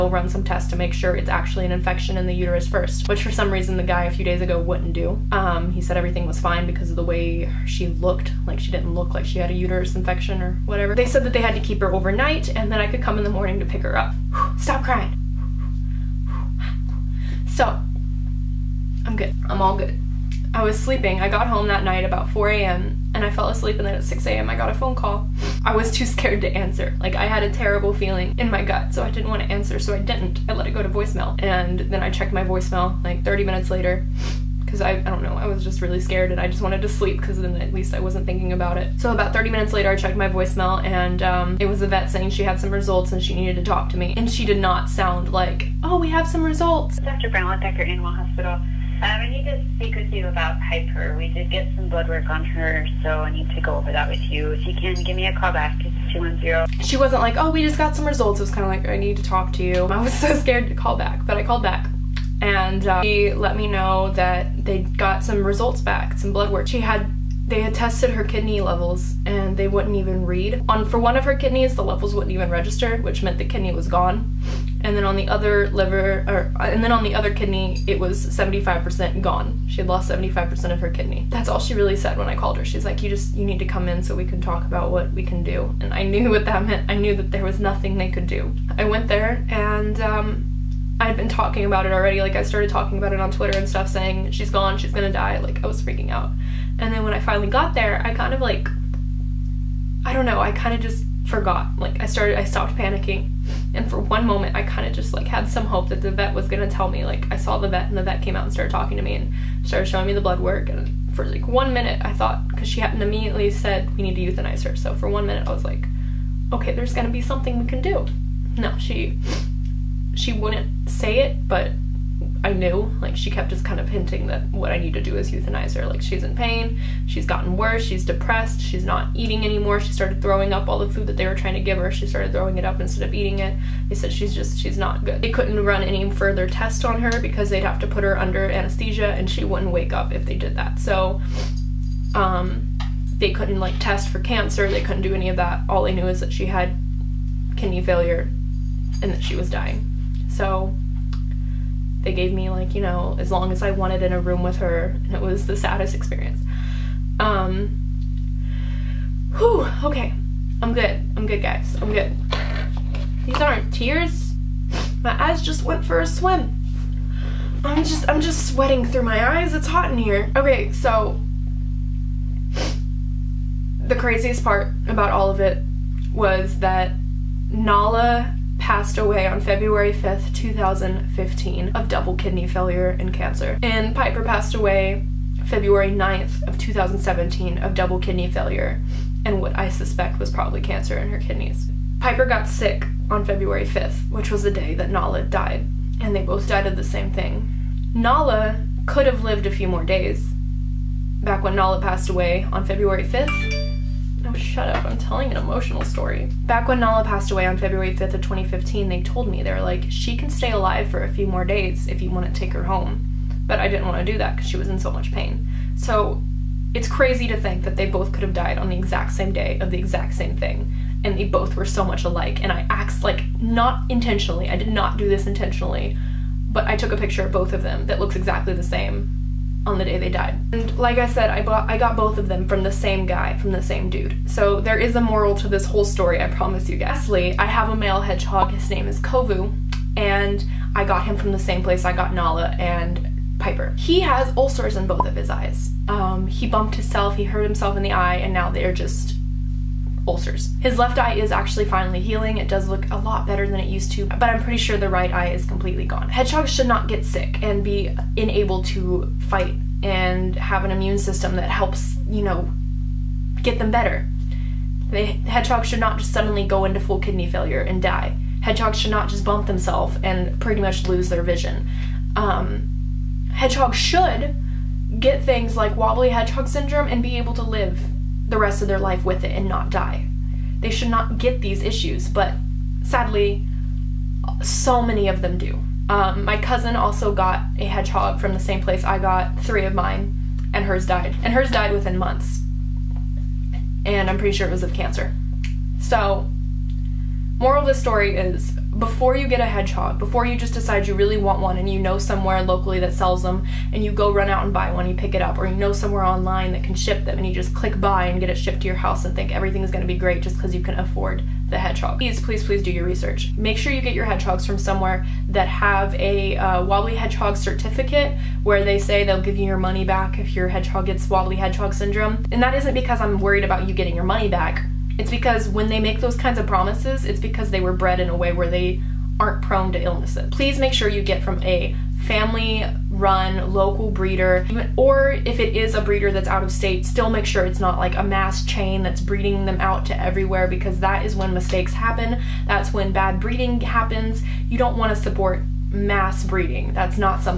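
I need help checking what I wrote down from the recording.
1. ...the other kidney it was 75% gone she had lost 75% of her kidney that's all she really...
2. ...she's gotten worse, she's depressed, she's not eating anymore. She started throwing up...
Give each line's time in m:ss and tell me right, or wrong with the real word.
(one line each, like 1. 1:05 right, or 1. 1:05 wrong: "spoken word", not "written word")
1. 1:17 right
2. 2:07 right.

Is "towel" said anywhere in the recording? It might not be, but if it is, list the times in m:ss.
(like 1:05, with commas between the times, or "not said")
not said.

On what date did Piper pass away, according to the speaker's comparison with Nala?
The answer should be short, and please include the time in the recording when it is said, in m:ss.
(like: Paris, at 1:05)
February 9, at 3:05.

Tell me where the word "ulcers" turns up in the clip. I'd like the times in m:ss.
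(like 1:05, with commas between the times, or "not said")
4:04, 4:10.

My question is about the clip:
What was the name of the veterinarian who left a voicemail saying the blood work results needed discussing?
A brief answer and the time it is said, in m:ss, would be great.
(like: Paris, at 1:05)
Dr. Brown, at 0:47.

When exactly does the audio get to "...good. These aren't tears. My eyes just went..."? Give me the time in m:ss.
2:41.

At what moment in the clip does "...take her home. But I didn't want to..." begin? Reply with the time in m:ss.
3:32.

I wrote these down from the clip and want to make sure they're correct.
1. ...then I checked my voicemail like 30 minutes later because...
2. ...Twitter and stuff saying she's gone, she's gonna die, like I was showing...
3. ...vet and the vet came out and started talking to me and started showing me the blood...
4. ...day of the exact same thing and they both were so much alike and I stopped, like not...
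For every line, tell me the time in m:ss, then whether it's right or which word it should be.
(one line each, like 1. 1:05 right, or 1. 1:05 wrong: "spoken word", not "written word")
1. 0:31 right
2. 1:33 wrong: "freaking", not "showing"
3. 1:47 right
4. 3:39 wrong: "asked", not "stopped".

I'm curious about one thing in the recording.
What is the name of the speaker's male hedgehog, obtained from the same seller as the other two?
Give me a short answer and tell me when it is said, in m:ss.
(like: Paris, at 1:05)
Kovu, at 3:58.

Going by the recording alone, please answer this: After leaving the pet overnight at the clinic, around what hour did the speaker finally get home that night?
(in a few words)
4 a.m.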